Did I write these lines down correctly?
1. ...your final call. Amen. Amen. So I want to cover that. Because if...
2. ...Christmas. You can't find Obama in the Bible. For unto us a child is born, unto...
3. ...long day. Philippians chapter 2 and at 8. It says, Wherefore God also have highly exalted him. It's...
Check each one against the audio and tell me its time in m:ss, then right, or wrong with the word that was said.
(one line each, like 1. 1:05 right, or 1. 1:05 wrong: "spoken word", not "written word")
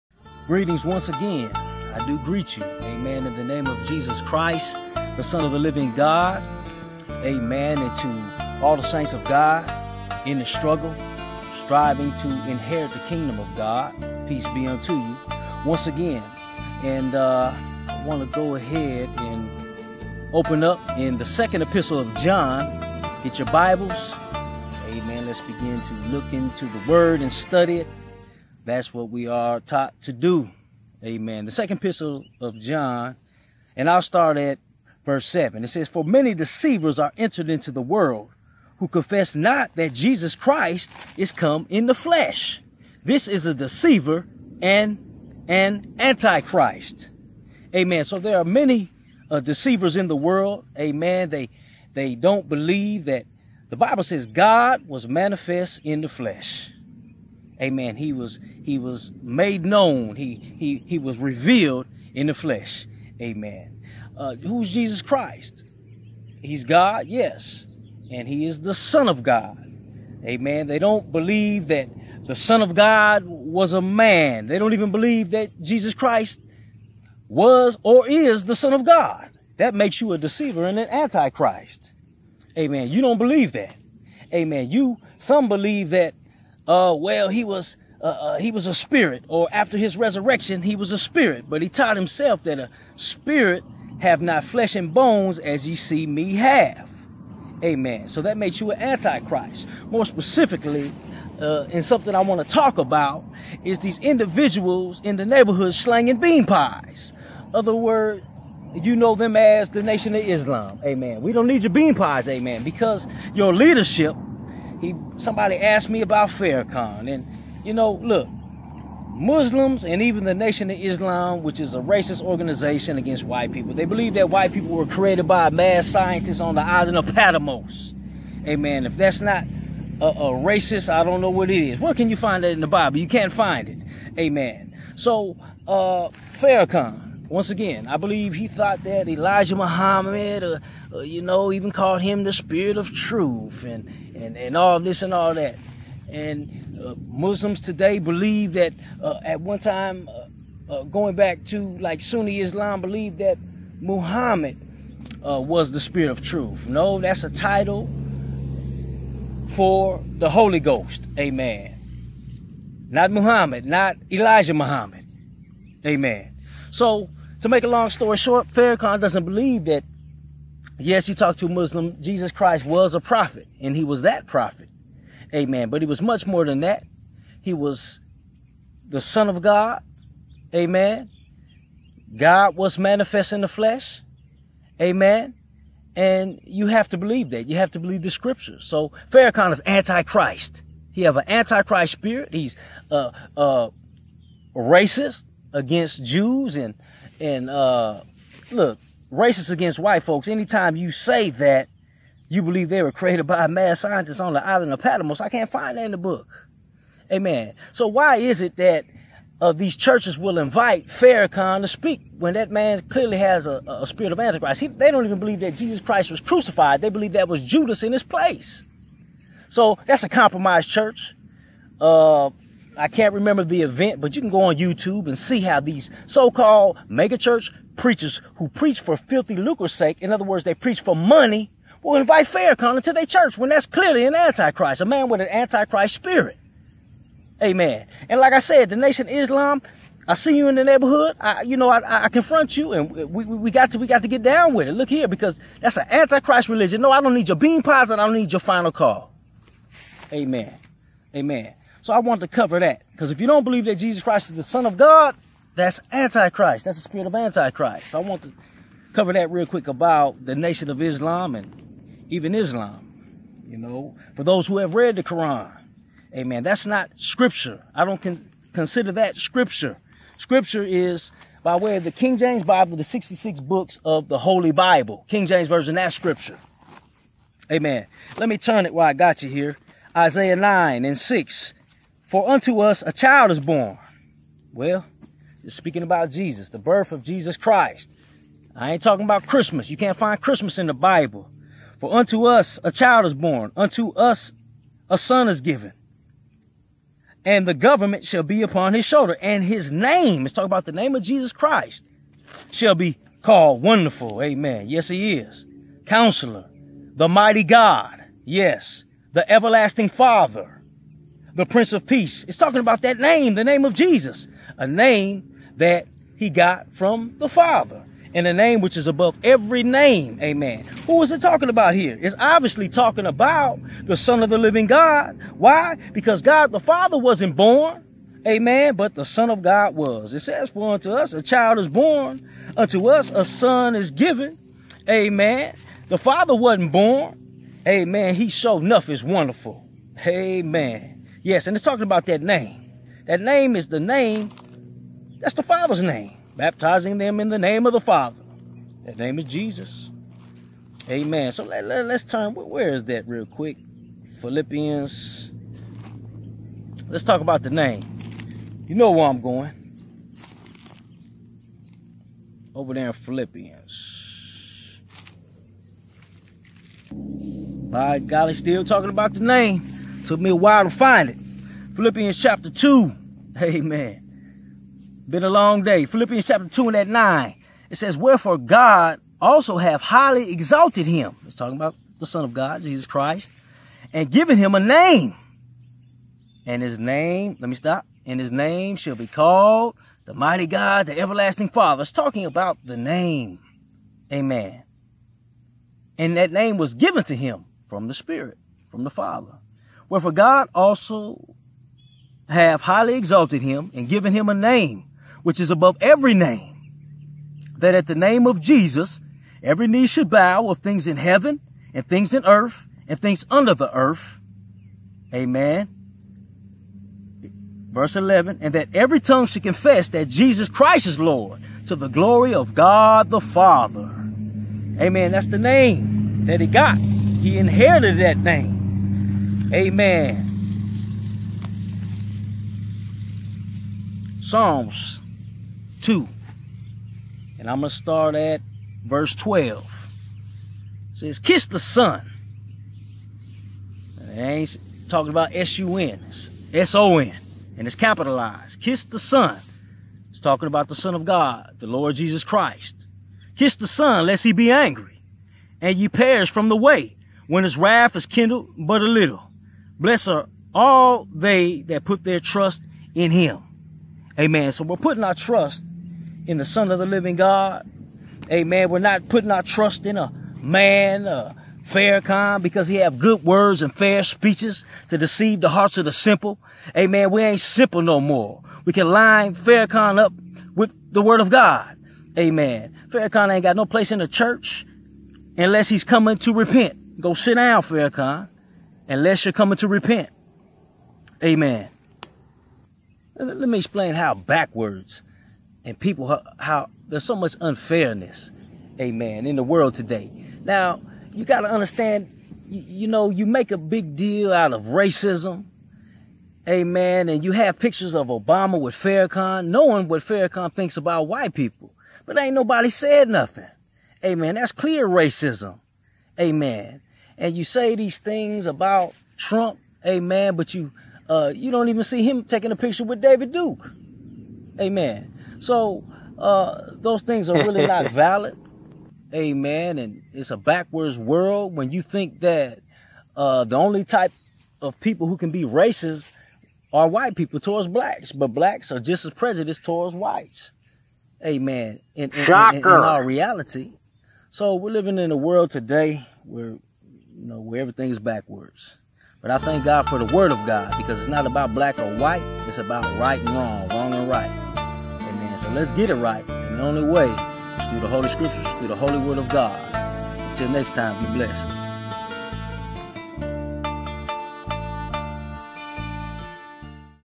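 1. 4:08 right
2. 4:49 wrong: "Christmas", not "Obama"
3. 6:15 wrong: "9", not "8".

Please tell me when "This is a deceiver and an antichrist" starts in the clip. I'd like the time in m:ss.
0:43.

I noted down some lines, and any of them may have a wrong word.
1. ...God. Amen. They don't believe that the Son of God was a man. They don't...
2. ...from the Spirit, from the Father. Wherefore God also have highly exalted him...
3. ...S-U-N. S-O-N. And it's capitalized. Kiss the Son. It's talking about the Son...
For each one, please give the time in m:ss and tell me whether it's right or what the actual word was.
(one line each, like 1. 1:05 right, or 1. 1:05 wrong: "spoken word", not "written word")
1. 1:09 right
2. 6:37 right
3. 7:25 right.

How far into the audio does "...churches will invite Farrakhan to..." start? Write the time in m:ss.
3:29.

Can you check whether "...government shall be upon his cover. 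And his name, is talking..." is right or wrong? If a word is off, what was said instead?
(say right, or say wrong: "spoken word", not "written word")
wrong: "shoulder", not "cover".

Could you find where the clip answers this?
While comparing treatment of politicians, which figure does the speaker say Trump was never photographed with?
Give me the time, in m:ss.
8:42.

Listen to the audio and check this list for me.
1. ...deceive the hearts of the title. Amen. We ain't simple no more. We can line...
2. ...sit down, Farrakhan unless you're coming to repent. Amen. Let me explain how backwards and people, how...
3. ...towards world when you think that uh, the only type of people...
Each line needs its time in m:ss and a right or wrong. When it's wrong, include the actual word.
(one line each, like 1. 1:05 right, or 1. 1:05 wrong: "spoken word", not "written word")
1. 7:54 wrong: "simple", not "title"
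2. 8:07 right
3. 8:50 wrong: "backwards", not "towards".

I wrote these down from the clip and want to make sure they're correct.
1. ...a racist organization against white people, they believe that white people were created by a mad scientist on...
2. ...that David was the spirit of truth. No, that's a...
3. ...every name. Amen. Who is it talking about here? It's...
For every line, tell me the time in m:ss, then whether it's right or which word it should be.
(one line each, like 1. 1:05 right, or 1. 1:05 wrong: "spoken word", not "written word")
1. 2:01 right
2. 2:33 wrong: "Muhammad", not "David"
3. 5:19 right.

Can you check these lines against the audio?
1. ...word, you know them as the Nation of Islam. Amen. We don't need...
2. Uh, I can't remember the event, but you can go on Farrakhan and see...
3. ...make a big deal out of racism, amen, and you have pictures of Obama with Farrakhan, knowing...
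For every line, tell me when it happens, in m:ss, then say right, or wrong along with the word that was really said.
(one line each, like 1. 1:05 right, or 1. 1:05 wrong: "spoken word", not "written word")
1. 1:47 right
2. 3:41 wrong: "YouTube", not "Farrakhan"
3. 8:23 right.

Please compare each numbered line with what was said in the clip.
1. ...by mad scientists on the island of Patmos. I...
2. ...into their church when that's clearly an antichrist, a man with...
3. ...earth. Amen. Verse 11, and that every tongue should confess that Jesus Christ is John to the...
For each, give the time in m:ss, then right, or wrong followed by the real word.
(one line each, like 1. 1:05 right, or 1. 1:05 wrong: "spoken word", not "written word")
1. 3:23 right
2. 3:52 right
3. 6:53 wrong: "Lord", not "John".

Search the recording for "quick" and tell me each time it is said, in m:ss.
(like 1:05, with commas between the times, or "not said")
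4:19, 5:53.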